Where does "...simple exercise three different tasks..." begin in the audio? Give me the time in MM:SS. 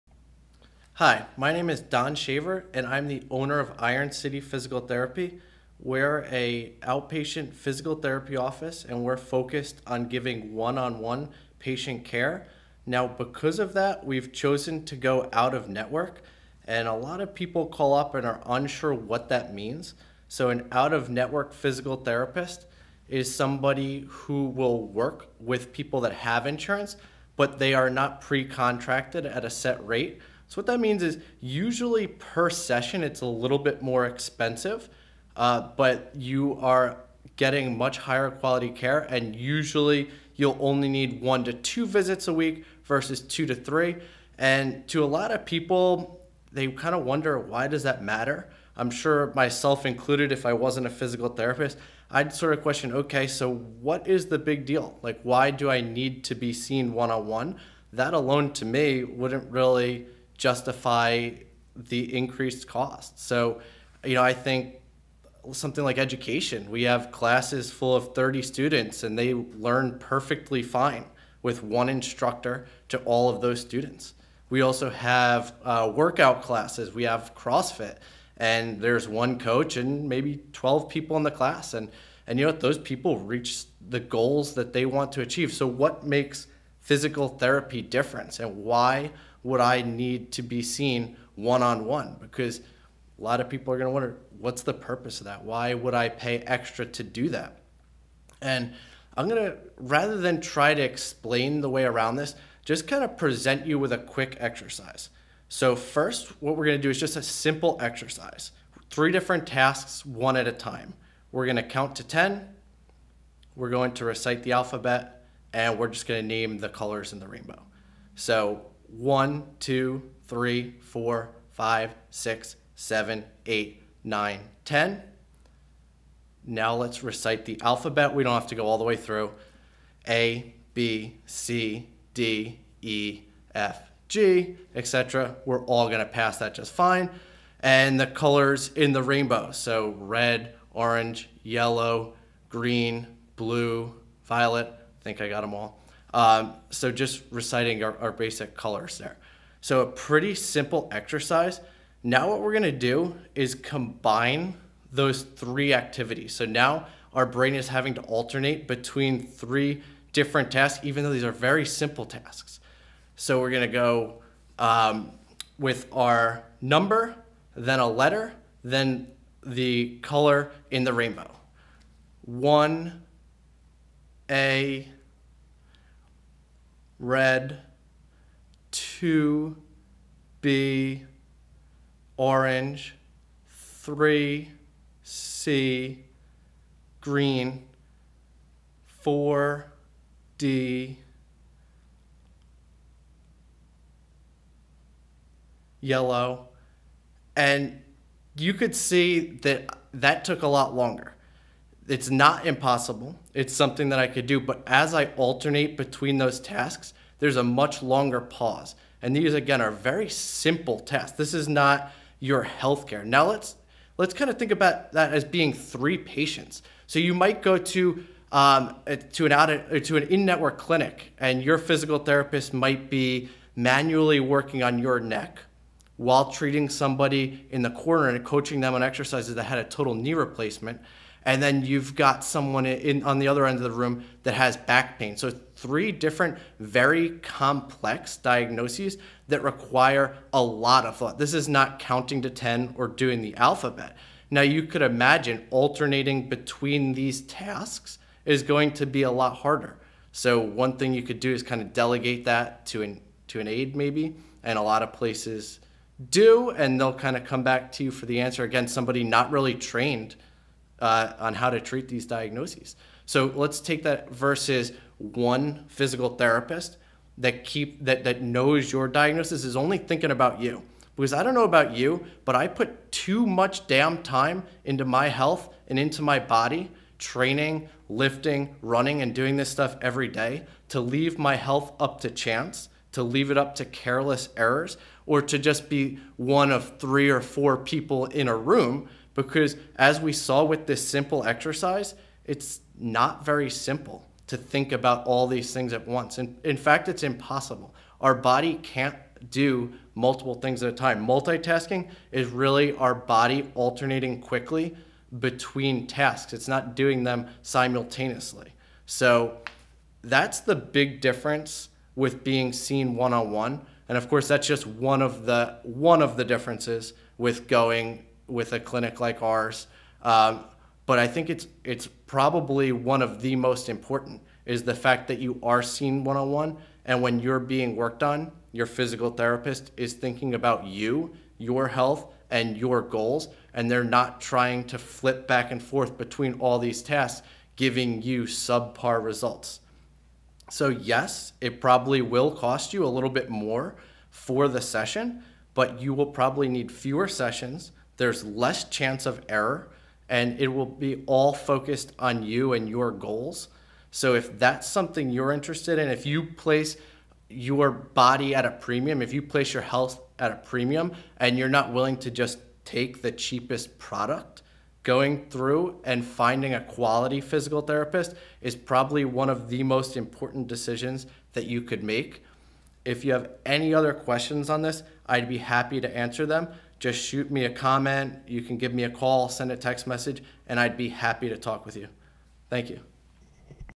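01:47.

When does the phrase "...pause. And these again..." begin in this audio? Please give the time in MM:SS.
03:28.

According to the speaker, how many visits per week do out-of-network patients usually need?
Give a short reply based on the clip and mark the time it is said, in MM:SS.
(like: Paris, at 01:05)
1 to 2, at 00:41.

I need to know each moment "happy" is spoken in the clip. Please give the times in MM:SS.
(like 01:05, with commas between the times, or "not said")
06:15, 06:20.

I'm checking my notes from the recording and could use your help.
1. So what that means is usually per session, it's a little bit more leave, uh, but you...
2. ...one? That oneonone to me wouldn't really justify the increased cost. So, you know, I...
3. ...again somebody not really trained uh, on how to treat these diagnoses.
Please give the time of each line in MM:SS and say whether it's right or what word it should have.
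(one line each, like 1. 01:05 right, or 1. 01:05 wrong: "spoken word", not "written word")
1. 00:30 wrong: "expensive", not "leave"
2. 00:57 wrong: "alone", not "oneonone"
3. 04:18 right.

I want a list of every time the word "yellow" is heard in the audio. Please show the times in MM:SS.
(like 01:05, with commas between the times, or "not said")
02:21, 03:15.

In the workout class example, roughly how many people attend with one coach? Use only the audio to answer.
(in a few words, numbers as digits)
12.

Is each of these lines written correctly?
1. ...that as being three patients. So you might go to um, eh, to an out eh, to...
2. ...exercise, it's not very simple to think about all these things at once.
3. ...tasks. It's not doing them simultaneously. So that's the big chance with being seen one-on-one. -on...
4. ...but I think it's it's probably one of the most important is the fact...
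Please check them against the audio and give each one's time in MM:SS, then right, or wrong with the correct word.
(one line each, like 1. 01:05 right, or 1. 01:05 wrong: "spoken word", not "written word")
1. 03:34 right
2. 04:51 right
3. 05:05 wrong: "difference", not "chance"
4. 05:20 right.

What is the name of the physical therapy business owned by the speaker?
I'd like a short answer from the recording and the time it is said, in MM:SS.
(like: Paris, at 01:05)
Iron City Physical Therapy, at 00:03.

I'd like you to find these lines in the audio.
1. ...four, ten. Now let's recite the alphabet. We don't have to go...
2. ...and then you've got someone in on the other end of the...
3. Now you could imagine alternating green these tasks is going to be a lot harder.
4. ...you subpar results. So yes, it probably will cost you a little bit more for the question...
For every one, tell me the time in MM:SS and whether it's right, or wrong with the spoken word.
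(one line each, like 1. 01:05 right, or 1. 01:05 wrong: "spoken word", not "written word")
1. 02:04 wrong: "nine", not "four"
2. 03:51 right
3. 04:04 wrong: "between", not "green"
4. 05:38 wrong: "session", not "question".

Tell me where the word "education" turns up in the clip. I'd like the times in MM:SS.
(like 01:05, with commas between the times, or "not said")
01:05.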